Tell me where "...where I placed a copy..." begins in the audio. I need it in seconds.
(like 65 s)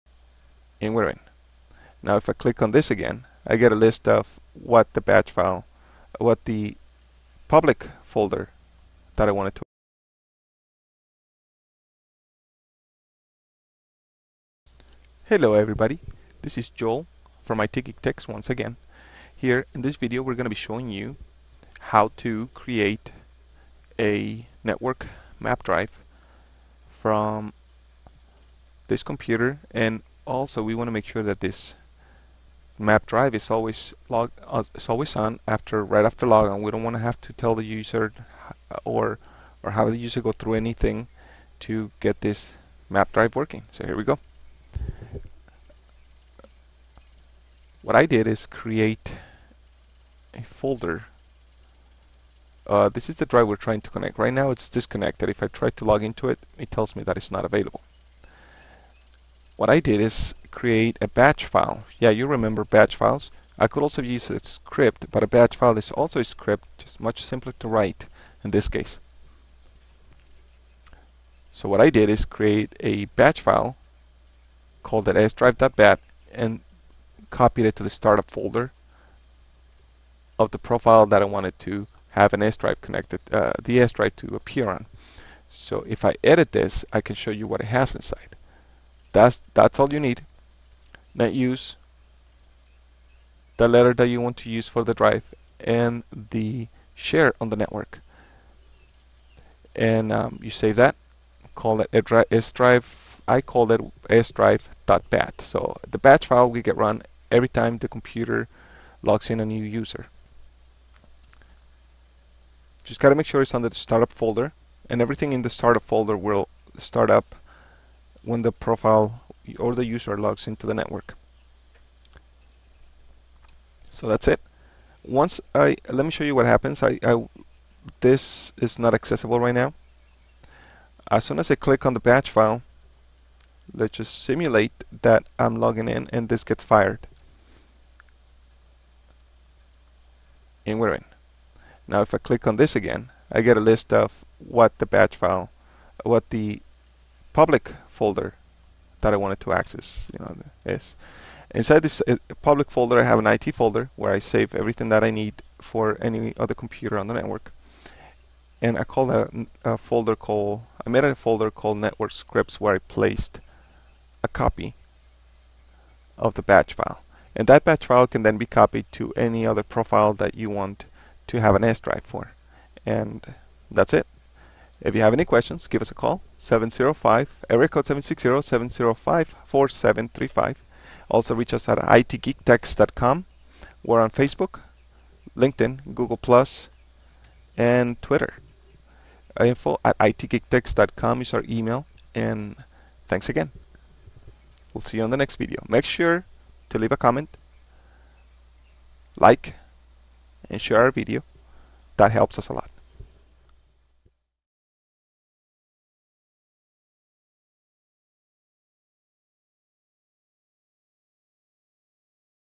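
162 s.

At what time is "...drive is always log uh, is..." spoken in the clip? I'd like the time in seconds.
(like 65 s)
33 s.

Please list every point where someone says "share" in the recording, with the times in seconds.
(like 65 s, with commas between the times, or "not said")
96 s, 200 s.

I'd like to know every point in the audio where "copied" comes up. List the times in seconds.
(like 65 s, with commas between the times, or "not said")
77 s, 168 s.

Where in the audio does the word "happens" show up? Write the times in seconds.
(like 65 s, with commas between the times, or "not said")
126 s.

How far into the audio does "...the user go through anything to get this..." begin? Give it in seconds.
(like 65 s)
39 s.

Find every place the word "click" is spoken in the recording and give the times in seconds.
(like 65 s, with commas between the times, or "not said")
2 s, 131 s, 142 s.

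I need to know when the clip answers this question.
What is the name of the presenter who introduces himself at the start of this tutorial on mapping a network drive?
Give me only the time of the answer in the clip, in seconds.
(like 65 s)
16 s.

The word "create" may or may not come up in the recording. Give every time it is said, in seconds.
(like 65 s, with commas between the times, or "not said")
22 s, 48 s, 60 s, 72 s.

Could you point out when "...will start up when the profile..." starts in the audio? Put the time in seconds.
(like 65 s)
116 s.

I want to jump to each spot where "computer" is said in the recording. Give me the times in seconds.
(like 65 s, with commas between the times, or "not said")
29 s, 107 s, 156 s.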